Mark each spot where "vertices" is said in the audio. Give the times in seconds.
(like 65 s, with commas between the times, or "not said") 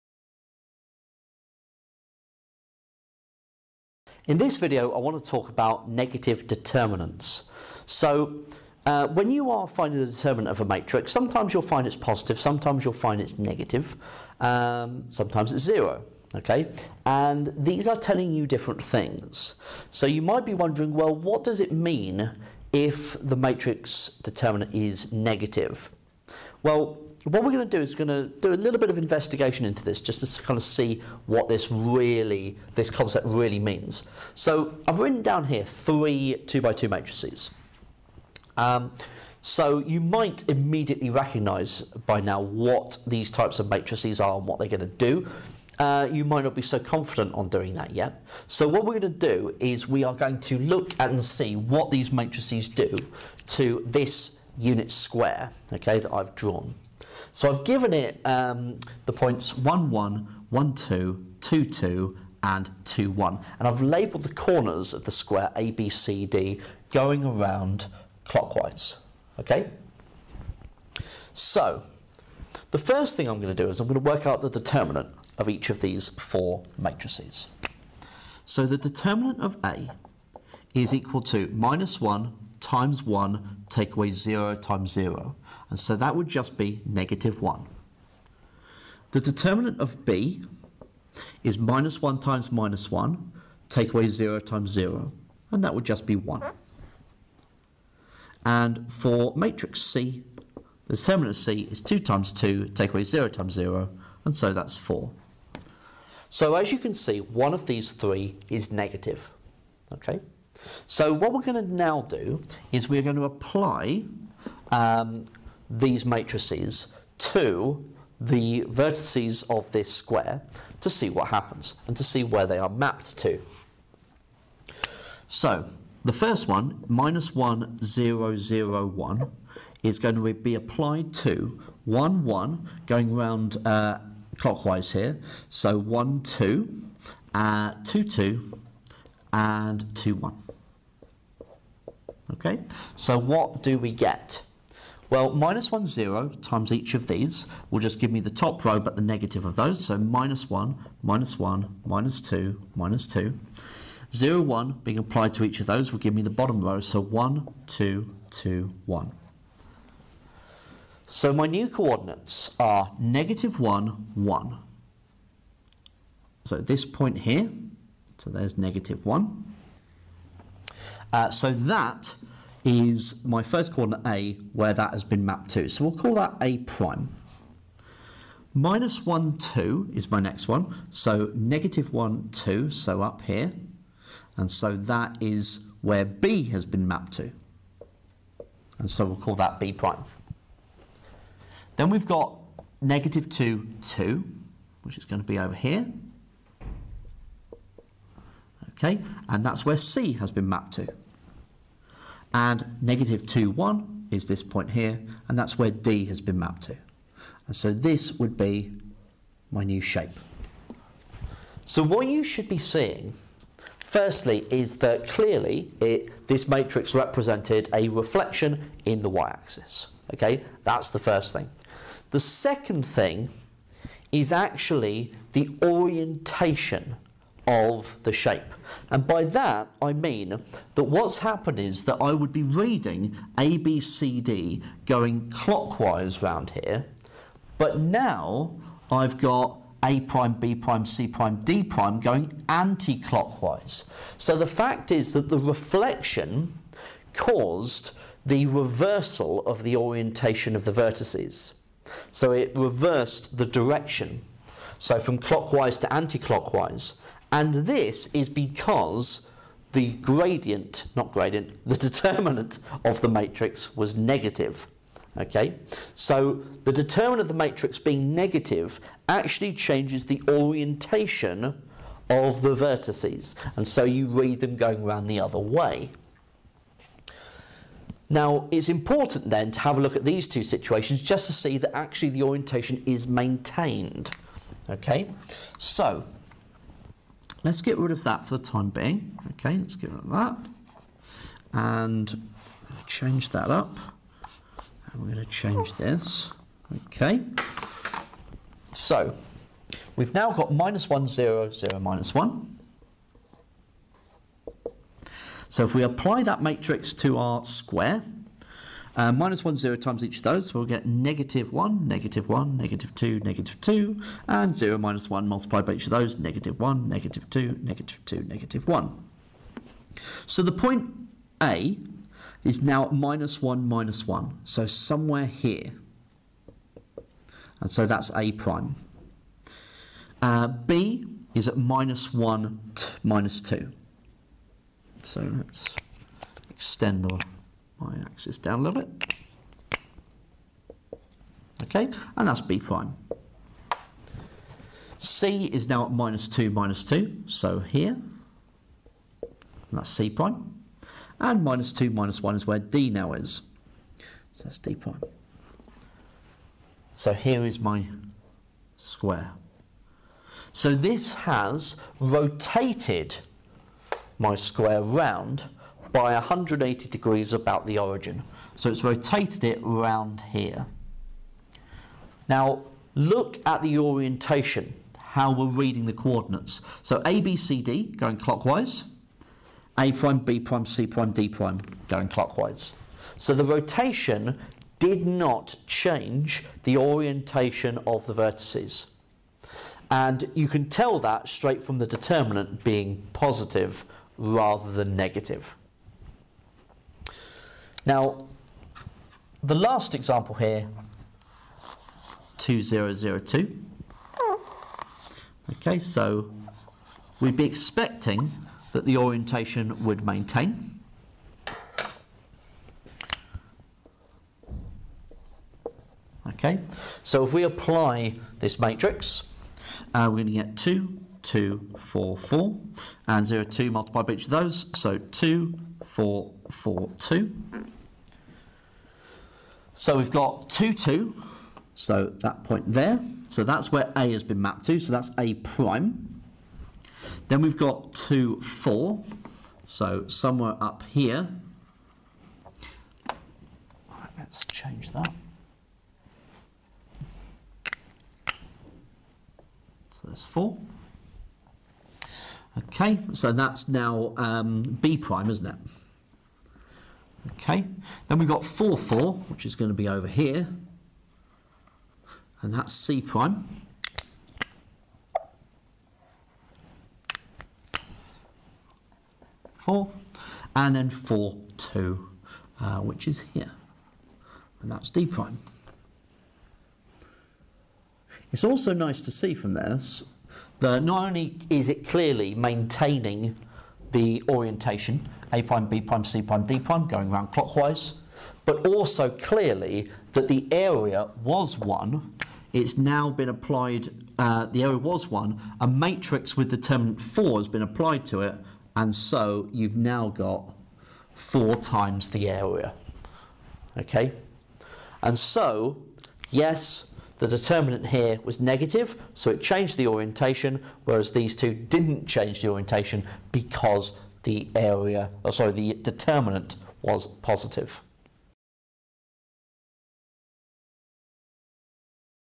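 118 s, 250 s, 272 s, 388 s.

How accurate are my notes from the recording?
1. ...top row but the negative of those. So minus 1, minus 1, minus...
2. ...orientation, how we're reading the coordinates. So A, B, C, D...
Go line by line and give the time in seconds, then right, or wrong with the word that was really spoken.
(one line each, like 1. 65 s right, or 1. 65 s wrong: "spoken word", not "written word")
1. 148 s right
2. 373 s right.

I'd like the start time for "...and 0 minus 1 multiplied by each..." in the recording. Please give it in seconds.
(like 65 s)
314 s.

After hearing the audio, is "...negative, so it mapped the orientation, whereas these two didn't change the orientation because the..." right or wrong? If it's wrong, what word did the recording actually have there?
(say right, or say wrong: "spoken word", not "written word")
wrong: "changed", not "mapped".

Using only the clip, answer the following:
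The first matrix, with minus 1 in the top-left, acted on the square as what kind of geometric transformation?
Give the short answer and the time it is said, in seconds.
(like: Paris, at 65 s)
reflection in the y-axis, at 217 s.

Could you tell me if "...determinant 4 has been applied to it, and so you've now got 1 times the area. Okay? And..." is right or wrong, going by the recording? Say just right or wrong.
wrong.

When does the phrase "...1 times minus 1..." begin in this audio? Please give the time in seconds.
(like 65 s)
92 s.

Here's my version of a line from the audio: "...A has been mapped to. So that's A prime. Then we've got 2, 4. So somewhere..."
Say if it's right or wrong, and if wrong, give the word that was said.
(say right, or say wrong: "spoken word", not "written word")
right.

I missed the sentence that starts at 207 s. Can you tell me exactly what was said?
And so this would be my new shape.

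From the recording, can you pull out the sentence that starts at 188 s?
And so we'll call that B prime.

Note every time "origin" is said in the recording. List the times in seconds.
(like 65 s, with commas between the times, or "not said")
367 s.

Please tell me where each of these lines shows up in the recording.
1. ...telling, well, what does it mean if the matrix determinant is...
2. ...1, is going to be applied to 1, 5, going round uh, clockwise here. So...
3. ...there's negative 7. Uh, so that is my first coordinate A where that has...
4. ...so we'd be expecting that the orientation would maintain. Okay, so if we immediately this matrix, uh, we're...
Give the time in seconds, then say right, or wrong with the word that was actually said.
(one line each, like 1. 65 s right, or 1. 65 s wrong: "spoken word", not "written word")
1. 20 s wrong: "wondering", not "telling"
2. 128 s wrong: "1", not "5"
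3. 168 s wrong: "1", not "7"
4. 405 s wrong: "apply", not "immediately".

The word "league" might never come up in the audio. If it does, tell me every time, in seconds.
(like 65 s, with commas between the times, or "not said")
not said.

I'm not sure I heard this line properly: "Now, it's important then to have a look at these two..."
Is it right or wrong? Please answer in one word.
right.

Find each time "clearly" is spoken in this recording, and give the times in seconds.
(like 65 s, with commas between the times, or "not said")
215 s, 481 s, 489 s.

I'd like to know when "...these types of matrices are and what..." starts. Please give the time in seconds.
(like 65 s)
43 s.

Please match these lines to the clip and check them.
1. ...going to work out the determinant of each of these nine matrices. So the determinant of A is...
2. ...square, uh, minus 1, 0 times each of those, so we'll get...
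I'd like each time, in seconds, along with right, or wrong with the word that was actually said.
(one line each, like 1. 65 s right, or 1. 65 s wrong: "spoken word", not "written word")
1. 73 s wrong: "four", not "nine"
2. 307 s right.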